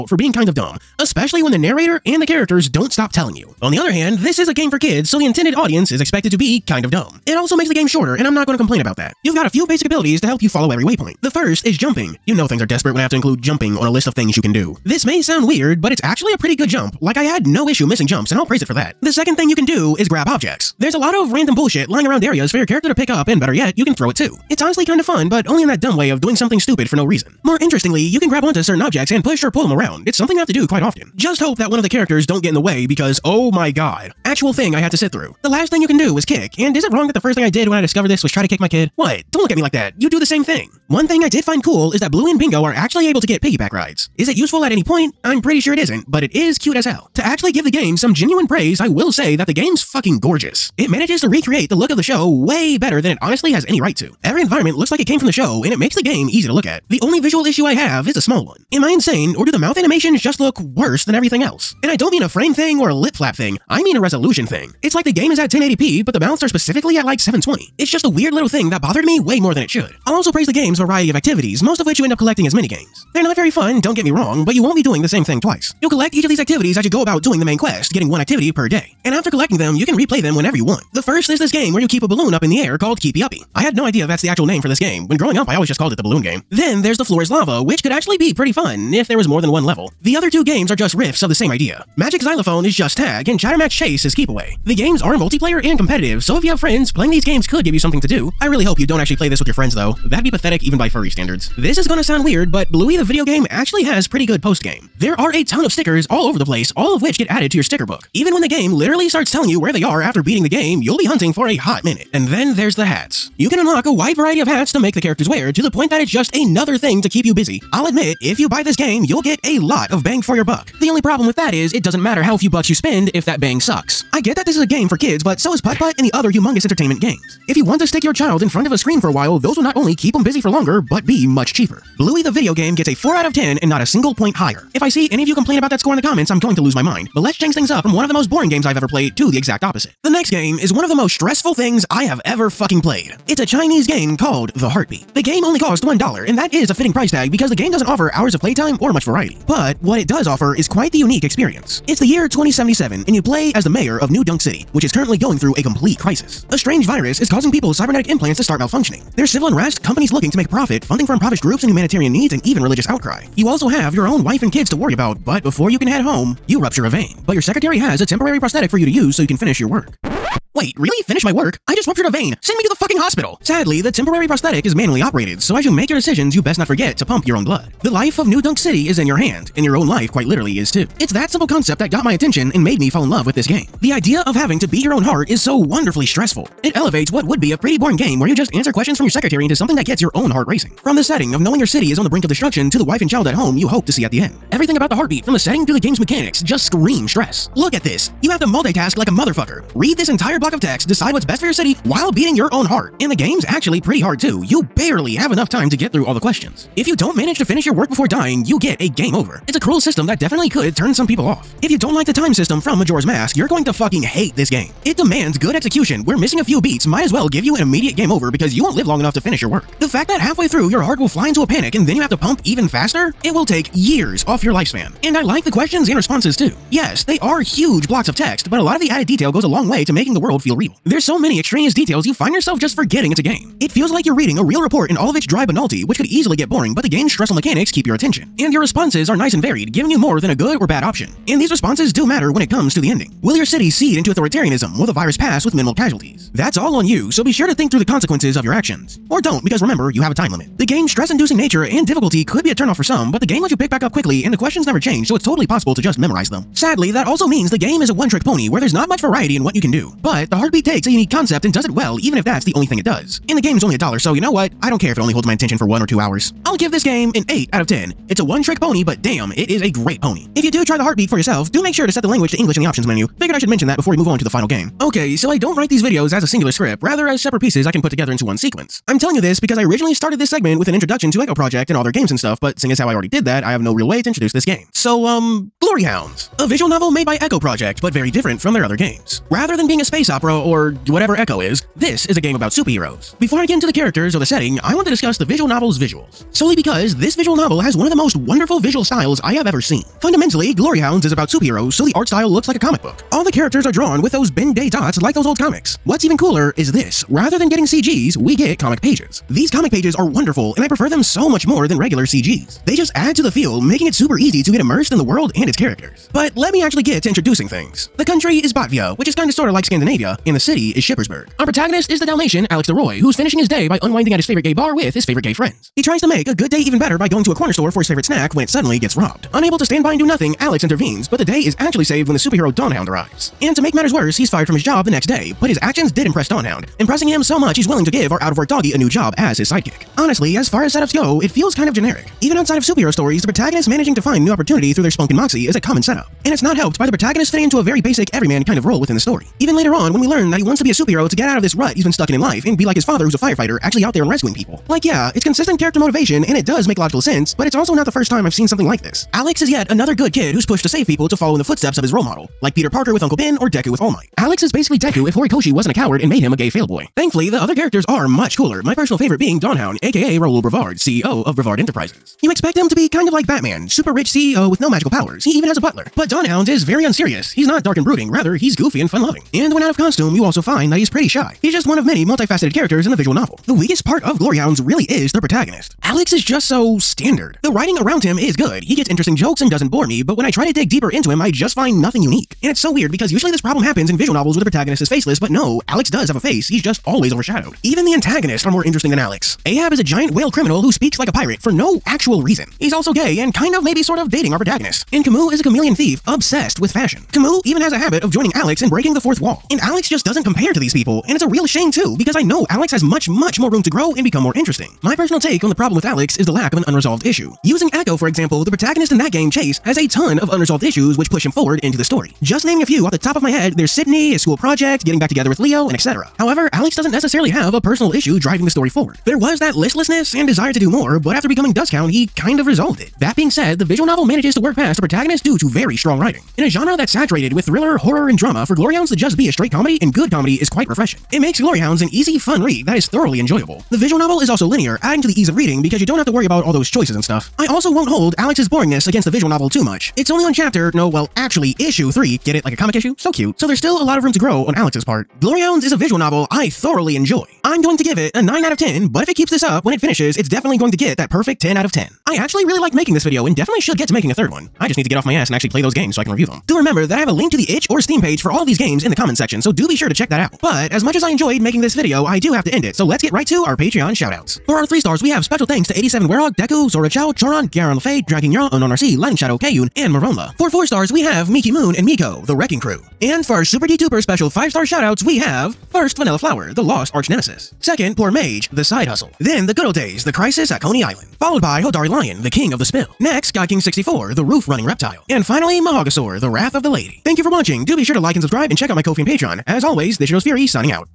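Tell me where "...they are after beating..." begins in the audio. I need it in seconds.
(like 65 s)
109 s.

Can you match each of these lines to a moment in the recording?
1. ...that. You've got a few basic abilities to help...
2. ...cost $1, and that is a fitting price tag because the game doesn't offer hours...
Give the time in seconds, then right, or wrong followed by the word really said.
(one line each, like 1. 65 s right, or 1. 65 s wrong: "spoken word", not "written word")
1. 8 s right
2. 145 s right.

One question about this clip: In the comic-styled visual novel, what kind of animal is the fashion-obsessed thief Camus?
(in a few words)
Chameleon.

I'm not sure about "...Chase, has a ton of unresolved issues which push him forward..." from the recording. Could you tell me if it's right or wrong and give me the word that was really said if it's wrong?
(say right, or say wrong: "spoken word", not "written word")
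right.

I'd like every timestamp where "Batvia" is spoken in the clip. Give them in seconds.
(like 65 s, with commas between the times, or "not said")
318 s.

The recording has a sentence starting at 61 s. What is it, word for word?
And I don't mean a frame thing or a lip flap thing, I mean a resolution thing.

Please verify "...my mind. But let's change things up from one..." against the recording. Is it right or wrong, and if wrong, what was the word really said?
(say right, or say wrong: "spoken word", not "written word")
right.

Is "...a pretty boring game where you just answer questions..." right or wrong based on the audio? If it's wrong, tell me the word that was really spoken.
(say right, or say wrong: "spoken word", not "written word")
right.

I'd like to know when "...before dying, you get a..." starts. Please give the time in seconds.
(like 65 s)
207 s.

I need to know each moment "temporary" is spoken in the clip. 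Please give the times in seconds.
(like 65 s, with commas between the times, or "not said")
168 s, 173 s.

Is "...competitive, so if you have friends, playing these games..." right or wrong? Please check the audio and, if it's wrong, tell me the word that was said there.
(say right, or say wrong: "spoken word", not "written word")
right.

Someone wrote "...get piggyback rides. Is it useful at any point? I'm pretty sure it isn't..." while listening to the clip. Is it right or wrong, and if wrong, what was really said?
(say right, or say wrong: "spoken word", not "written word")
right.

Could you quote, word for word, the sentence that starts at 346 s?
And it's not helped by the protagonist fitting into a very basic everyman kind of role within the story.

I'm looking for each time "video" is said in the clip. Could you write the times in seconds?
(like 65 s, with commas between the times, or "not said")
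103 s, 132 s, 275 s, 463 s, 471 s.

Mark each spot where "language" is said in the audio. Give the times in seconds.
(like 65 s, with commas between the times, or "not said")
272 s.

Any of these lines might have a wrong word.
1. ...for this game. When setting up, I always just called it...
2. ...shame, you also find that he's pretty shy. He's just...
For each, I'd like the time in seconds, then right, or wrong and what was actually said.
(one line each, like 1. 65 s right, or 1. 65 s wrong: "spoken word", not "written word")
1. 84 s wrong: "growing", not "setting"
2. 379 s wrong: "costume", not "shame".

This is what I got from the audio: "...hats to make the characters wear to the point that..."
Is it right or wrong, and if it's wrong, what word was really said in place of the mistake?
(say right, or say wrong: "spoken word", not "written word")
right.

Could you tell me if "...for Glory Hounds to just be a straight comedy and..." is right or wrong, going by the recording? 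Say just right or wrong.
right.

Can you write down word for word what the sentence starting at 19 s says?
The second thing you can do is grab objects.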